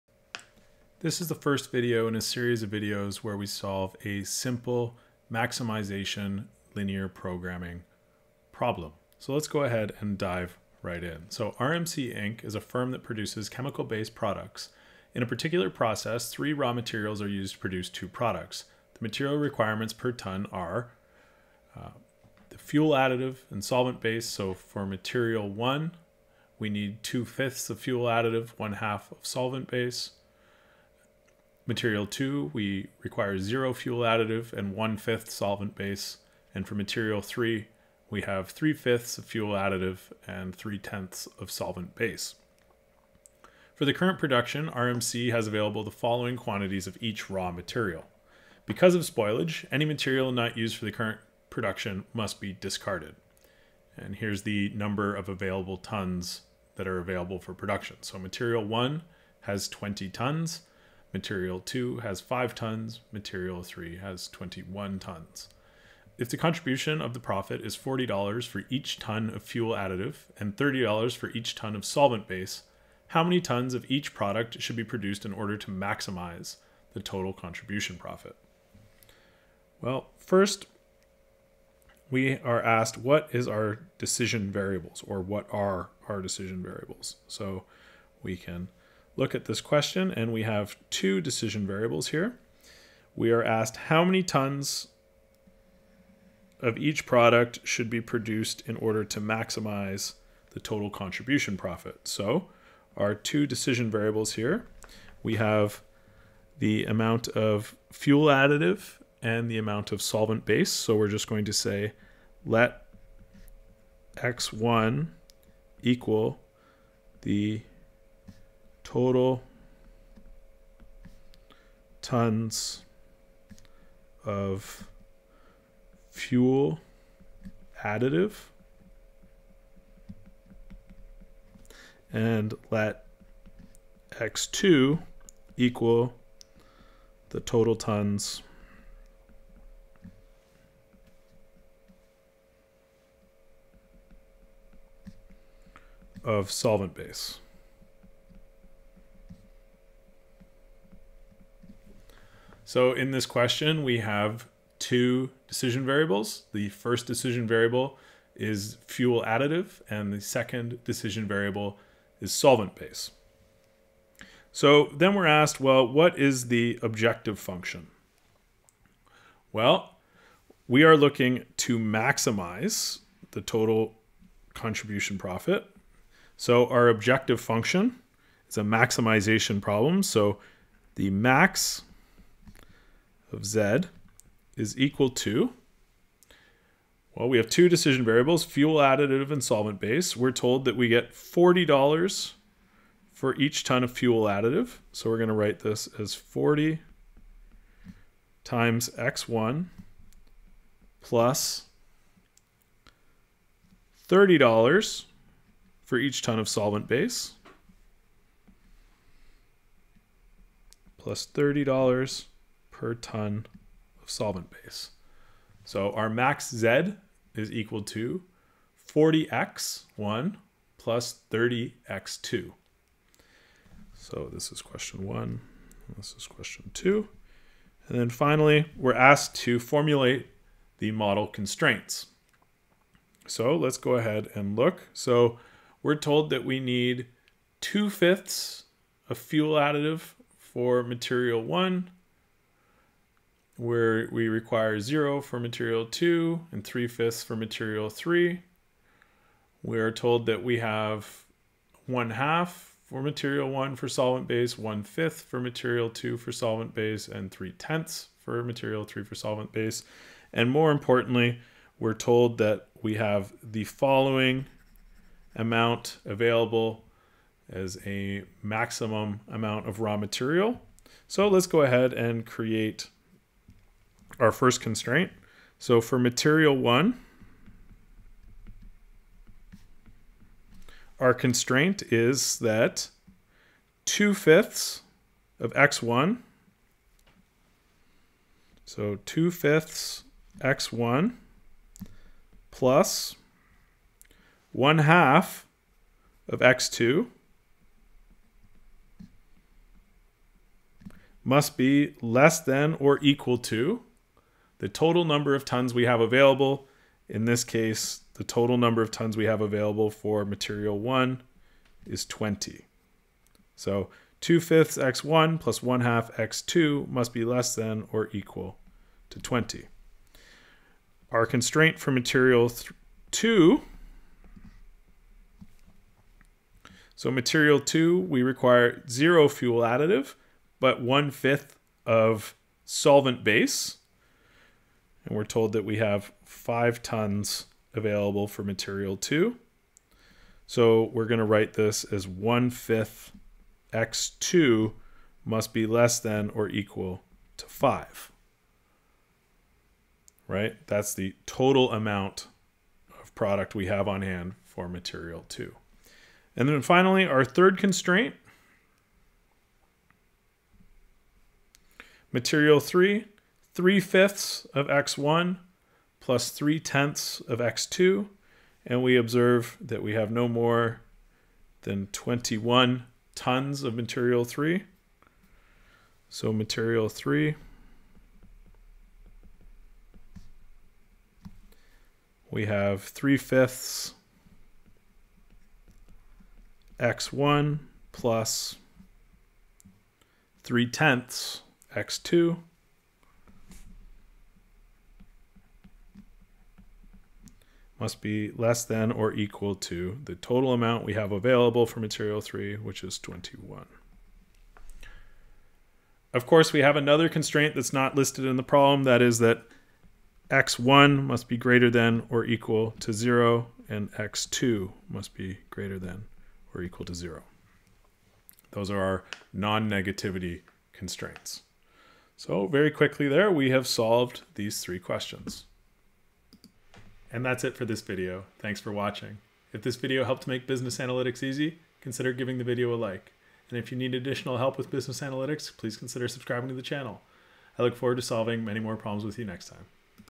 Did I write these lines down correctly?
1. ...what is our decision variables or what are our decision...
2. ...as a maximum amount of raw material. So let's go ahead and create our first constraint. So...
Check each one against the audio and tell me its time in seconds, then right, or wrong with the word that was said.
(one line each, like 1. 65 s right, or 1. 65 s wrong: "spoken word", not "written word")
1. 82 s right
2. 267 s right.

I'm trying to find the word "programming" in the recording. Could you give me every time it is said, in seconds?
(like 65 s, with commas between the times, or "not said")
7 s.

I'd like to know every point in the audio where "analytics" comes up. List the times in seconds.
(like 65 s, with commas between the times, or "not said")
430 s, 435 s.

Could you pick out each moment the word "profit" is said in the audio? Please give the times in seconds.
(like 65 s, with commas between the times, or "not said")
67 s, 77 s, 101 s, 175 s.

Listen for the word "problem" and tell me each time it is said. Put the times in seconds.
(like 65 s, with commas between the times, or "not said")
8 s, 179 s, 408 s, 438 s.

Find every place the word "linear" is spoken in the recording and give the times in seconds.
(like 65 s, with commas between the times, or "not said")
6 s.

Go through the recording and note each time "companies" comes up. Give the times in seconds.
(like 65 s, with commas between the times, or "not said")
not said.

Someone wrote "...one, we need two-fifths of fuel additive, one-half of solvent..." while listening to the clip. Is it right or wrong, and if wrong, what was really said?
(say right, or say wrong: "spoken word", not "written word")
right.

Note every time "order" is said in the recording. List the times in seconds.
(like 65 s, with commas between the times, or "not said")
75 s, 98 s.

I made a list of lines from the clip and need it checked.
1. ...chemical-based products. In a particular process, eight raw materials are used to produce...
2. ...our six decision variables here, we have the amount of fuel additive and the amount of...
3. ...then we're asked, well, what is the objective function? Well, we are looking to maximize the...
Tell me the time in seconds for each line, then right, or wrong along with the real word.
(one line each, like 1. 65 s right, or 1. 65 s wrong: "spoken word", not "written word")
1. 13 s wrong: "three", not "eight"
2. 102 s wrong: "two", not "six"
3. 164 s right.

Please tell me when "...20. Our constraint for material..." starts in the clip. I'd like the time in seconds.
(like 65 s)
319 s.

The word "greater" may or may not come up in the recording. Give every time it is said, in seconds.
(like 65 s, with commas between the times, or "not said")
411 s, 415 s.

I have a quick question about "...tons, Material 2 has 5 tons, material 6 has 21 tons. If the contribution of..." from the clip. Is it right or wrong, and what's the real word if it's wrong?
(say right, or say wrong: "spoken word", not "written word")
wrong: "3", not "6".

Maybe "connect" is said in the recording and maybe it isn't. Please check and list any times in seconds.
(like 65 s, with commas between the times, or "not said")
not said.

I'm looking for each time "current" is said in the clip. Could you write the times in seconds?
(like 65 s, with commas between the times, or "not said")
43 s, 50 s.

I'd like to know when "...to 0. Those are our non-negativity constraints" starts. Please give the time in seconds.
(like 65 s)
416 s.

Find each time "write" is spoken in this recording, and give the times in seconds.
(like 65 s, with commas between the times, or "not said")
195 s, 341 s.